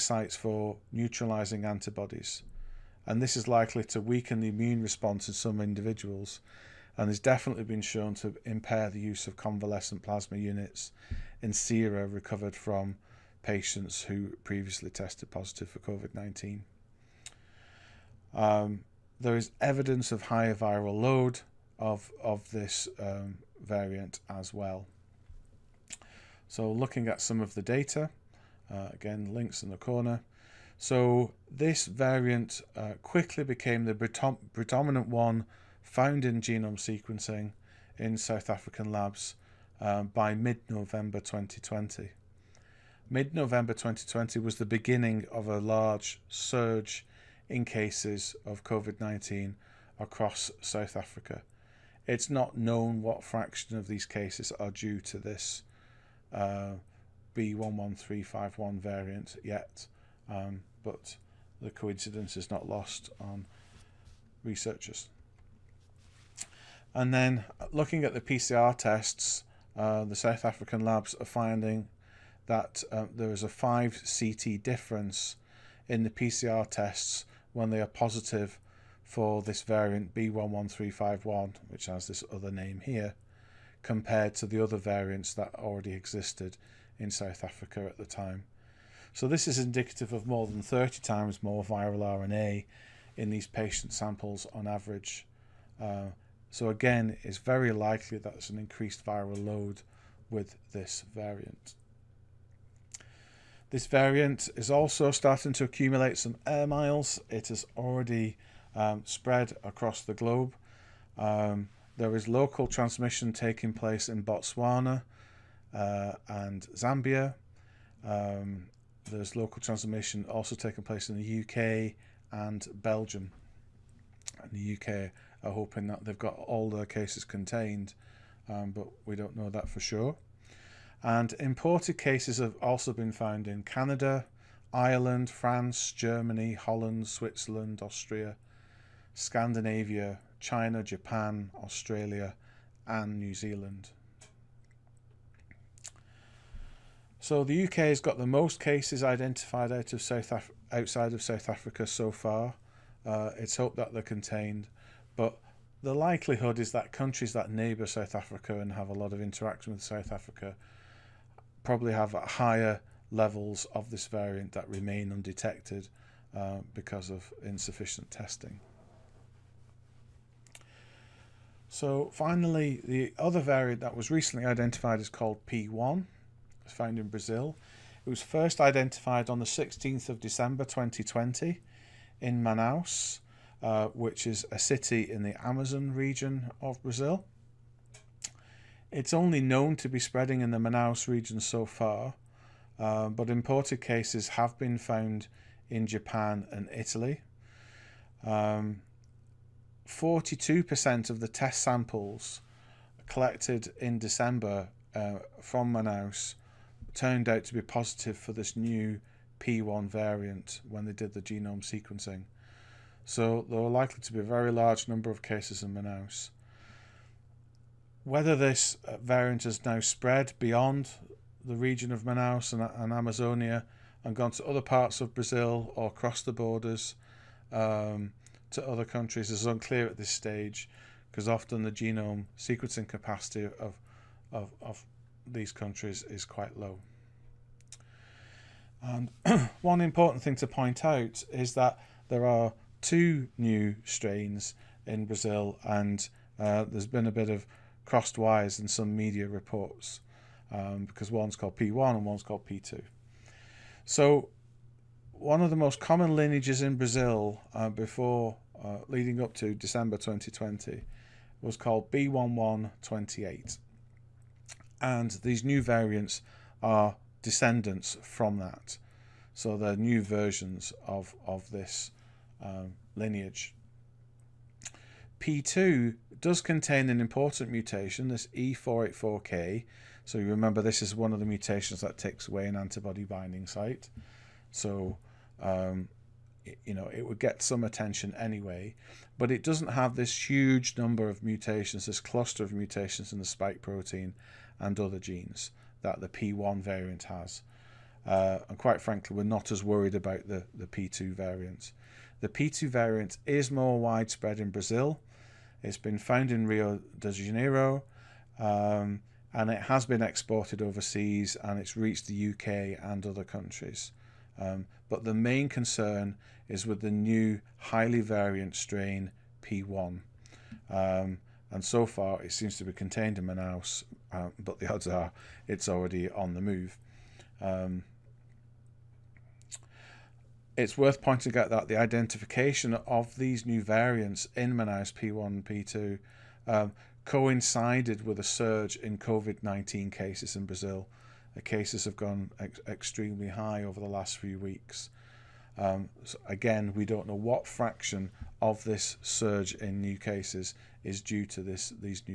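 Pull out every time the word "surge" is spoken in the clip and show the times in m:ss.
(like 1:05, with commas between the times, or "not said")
0:46, 5:38, 5:49.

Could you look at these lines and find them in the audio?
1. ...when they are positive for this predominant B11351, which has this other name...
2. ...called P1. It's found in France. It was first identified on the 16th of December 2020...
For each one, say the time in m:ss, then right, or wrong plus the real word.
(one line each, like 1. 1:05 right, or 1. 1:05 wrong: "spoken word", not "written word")
1. 1:17 wrong: "variant", not "predominant"
2. 2:55 wrong: "Brazil", not "France".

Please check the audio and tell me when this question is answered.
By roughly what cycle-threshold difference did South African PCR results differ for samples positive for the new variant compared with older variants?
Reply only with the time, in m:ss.
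1:13.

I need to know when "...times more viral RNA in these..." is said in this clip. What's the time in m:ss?
1:31.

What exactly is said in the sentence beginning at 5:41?
The cases have gone ex- extremely high over the last few weeks.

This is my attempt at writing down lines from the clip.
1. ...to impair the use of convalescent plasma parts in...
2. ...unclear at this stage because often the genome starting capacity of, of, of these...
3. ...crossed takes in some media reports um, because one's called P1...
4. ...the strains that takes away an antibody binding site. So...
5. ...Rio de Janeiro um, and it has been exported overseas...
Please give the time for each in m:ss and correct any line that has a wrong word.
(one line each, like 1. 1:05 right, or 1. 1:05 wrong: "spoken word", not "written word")
1. 0:08 wrong: "units", not "parts"
2. 3:49 wrong: "sequencing", not "starting"
3. 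4:07 wrong: "wires", not "takes"
4. 4:41 wrong: "mutations", not "strains"
5. 5:06 right.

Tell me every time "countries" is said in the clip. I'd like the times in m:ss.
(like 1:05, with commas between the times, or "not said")
2:36, 3:48, 3:55, 5:13.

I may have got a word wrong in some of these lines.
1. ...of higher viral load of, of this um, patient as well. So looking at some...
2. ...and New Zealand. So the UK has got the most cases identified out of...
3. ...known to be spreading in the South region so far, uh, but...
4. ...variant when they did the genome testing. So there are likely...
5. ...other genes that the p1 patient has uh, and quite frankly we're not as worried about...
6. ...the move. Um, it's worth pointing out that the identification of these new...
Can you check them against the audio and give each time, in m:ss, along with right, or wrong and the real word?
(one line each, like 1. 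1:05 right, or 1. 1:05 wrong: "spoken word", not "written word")
1. 0:20 wrong: "variant", not "patient"
2. 2:22 right
3. 3:09 wrong: "Manaus", not "South"
4. 3:29 wrong: "sequencing", not "testing"
5. 4:54 wrong: "variant", not "patient"
6. 5:26 right.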